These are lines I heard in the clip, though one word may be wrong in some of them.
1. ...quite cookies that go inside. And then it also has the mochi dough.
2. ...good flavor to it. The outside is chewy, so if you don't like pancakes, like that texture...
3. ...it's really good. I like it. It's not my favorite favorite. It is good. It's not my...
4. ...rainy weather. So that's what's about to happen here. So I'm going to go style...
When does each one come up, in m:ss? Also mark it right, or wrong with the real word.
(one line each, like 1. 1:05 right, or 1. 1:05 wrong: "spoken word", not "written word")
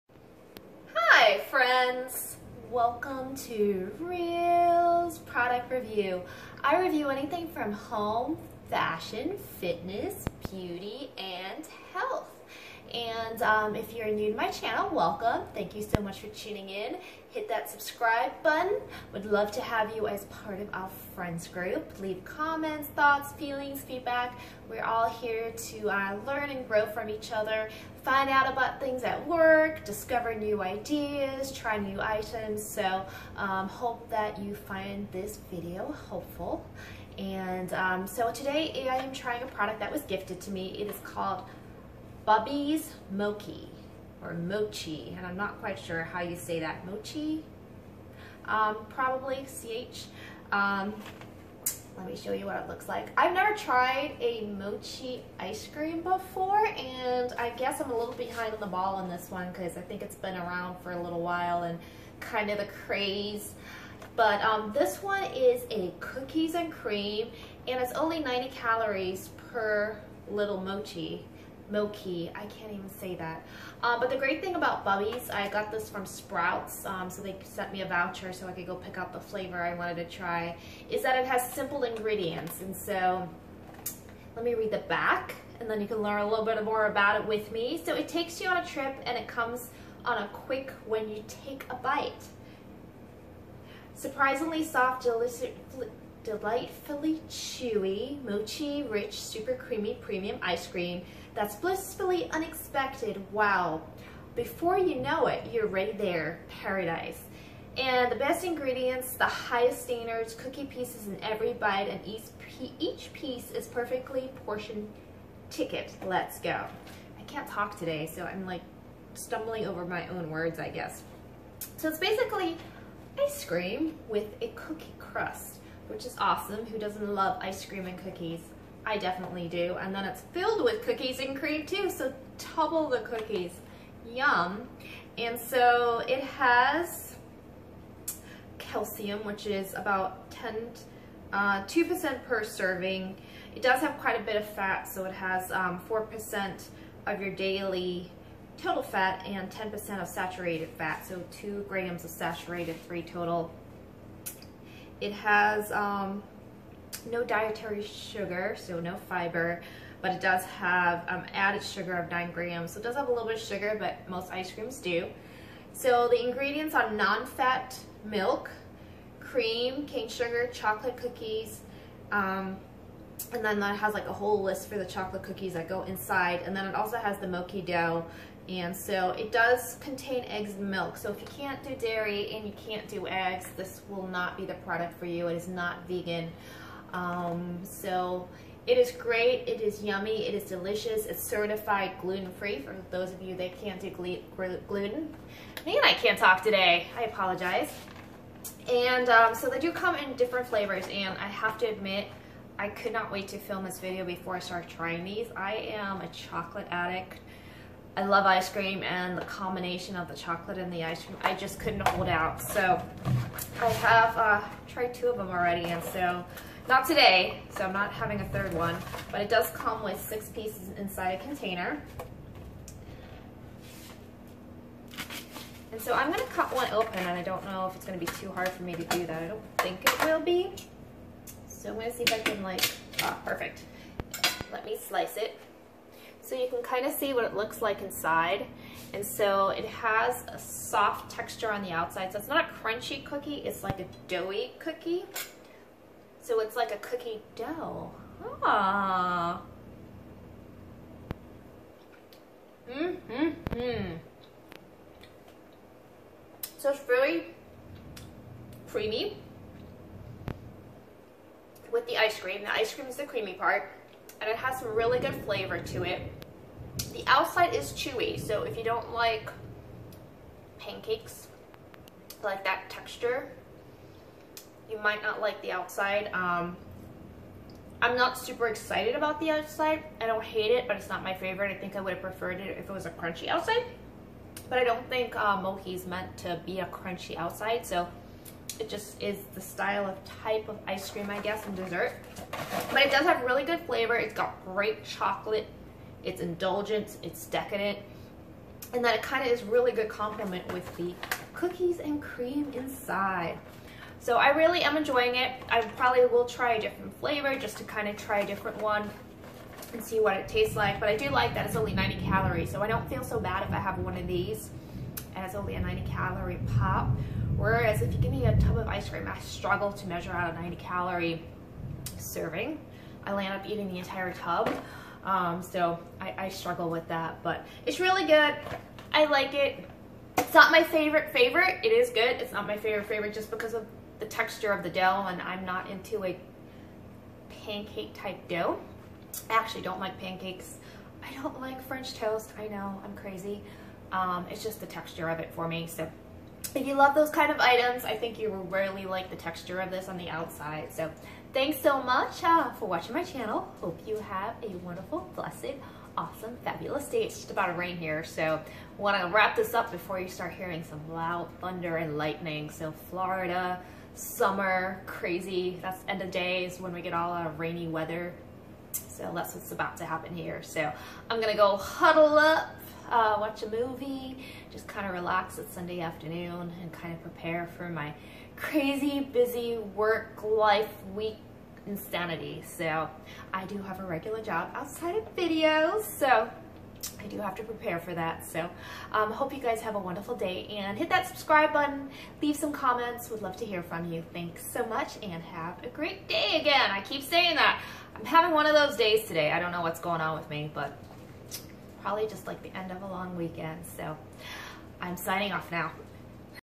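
1. 2:54 wrong: "chocolate", not "quite"
2. 4:24 right
3. 5:27 right
4. 6:07 wrong: "huddle", not "style".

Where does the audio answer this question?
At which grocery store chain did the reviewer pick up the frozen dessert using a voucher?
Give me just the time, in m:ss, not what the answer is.
1:16.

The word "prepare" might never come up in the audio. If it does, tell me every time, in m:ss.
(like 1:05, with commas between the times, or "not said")
6:17, 6:27.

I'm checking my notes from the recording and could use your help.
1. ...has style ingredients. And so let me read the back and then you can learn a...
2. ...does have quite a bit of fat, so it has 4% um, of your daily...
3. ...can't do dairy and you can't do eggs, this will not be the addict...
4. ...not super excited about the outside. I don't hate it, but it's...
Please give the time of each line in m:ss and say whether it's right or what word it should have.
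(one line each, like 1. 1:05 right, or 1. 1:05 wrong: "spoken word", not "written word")
1. 1:21 wrong: "simple", not "style"
2. 2:23 right
3. 3:01 wrong: "product", not "addict"
4. 4:37 right.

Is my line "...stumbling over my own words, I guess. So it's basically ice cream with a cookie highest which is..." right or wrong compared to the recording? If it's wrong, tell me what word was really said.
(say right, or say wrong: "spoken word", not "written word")
wrong: "crust", not "highest".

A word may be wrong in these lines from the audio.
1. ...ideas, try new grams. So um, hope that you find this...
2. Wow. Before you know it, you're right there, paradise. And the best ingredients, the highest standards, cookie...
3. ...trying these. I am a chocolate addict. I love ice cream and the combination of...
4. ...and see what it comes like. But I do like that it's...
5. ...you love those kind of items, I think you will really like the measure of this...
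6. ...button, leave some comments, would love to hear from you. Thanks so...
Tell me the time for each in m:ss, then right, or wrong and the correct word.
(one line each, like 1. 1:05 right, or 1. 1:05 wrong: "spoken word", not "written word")
1. 0:30 wrong: "items", not "grams"
2. 1:43 right
3. 3:24 right
4. 5:09 wrong: "tastes", not "comes"
5. 5:46 wrong: "texture", not "measure"
6. 6:31 right.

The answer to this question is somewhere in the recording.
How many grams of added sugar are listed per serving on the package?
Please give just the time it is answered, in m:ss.
2:42.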